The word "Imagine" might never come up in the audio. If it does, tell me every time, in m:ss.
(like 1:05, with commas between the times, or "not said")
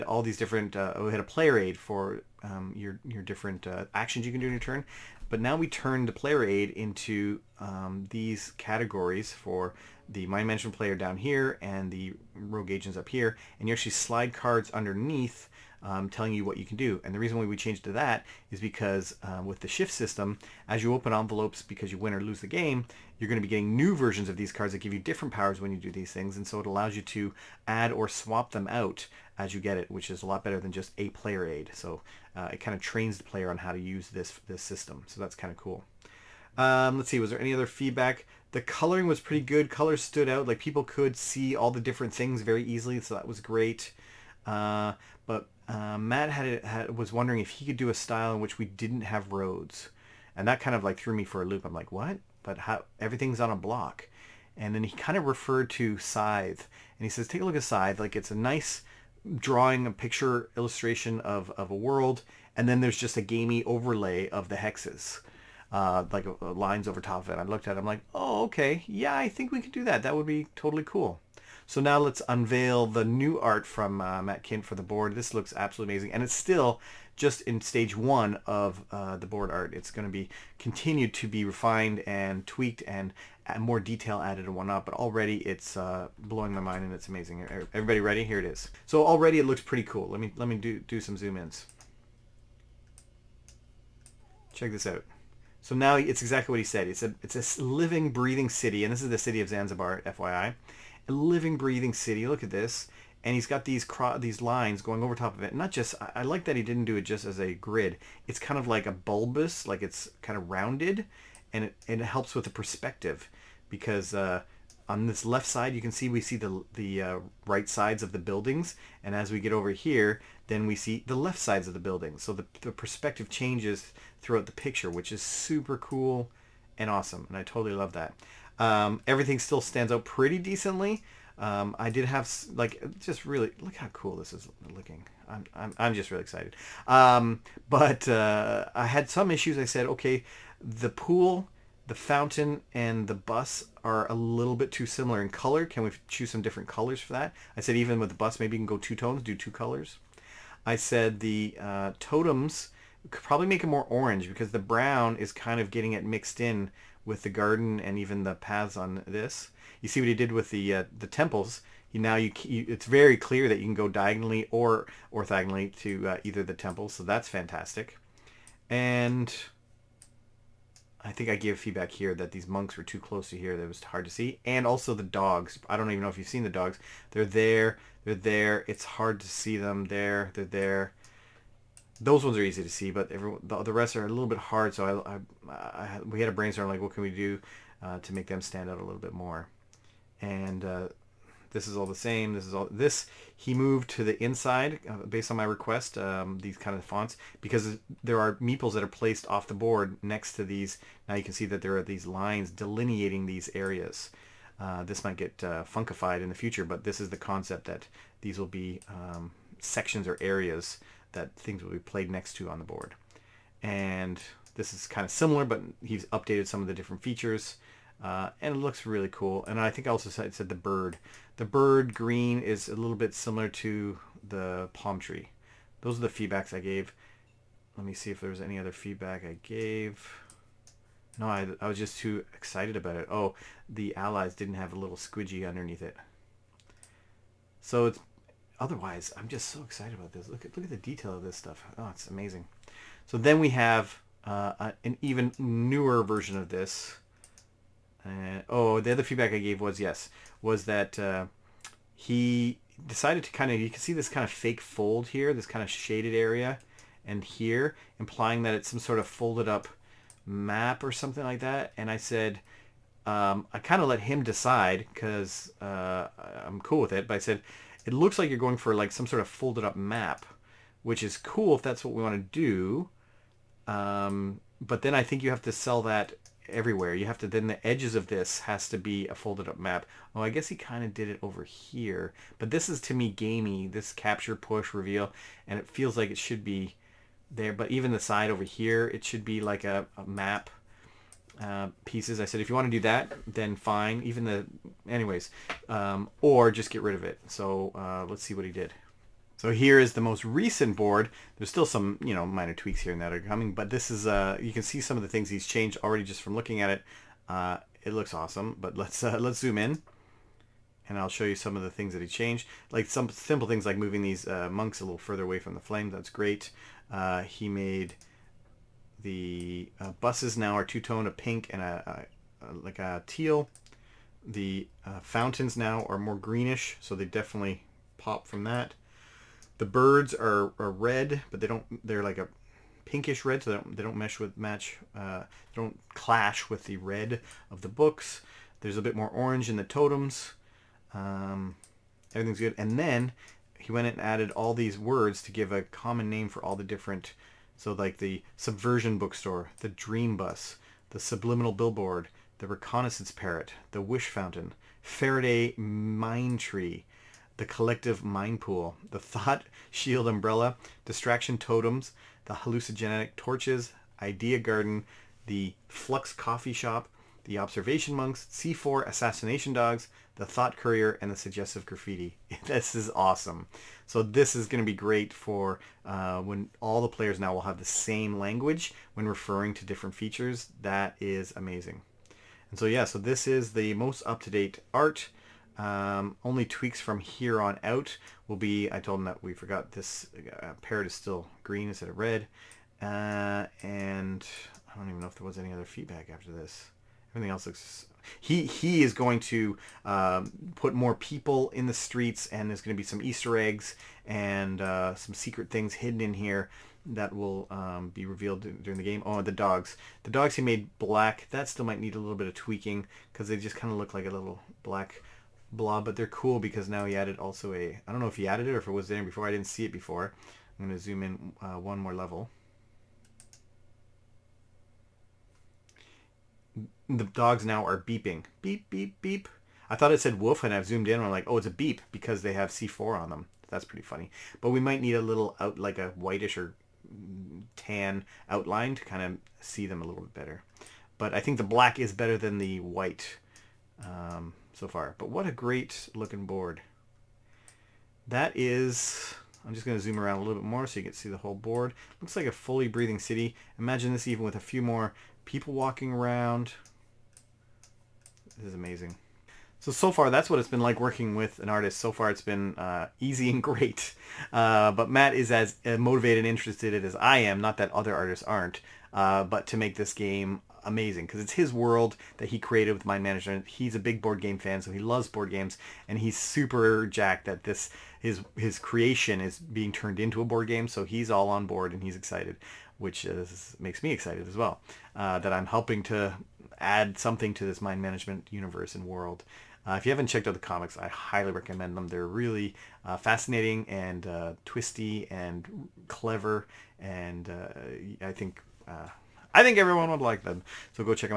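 7:33.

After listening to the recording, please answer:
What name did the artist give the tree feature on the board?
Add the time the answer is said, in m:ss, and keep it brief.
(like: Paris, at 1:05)
Faraday mine tree, at 5:54.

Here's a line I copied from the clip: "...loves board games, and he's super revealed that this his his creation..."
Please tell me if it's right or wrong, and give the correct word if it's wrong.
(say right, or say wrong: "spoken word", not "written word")
wrong: "jacked", not "revealed".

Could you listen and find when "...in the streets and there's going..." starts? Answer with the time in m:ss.
6:41.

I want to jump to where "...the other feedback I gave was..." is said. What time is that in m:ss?
4:08.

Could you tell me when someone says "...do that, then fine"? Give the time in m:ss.
4:52.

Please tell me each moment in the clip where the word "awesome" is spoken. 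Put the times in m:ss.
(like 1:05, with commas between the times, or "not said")
2:06, 5:08, 6:12.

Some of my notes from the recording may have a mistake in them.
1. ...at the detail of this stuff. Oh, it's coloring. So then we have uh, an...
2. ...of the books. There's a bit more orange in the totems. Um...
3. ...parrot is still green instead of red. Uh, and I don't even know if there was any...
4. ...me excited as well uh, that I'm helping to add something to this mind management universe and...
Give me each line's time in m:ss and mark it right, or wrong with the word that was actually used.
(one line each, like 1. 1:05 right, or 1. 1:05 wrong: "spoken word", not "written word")
1. 4:00 wrong: "amazing", not "coloring"
2. 5:37 right
3. 6:30 right
4. 8:03 right.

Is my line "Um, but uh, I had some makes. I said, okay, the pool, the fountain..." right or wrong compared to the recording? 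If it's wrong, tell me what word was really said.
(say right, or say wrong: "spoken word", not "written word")
wrong: "issues", not "makes".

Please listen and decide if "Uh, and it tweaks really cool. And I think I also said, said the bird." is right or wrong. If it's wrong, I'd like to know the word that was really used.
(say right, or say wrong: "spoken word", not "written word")
wrong: "looks", not "tweaks".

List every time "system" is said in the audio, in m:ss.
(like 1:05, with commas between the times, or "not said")
0:19, 0:34.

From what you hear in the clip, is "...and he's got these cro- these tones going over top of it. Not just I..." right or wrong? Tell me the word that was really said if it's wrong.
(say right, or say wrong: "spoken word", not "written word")
wrong: "lines", not "tones".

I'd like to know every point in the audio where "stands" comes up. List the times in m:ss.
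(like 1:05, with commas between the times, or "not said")
2:09, 3:08.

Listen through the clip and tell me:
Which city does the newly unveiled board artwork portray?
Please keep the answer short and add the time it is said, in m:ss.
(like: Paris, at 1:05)
Zanzibar, at 1:39.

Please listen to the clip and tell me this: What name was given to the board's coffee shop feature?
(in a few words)
Flux coffee shop.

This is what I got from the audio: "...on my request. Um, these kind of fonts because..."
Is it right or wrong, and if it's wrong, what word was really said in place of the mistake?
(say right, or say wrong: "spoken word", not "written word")
right.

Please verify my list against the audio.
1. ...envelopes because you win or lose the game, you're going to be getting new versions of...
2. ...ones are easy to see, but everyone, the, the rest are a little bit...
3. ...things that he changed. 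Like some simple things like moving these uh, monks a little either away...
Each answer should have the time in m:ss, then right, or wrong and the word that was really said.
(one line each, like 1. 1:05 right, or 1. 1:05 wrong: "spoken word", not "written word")
1. 0:21 right
2. 3:02 right
3. 5:11 wrong: "further", not "either".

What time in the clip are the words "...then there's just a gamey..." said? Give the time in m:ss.
1:02.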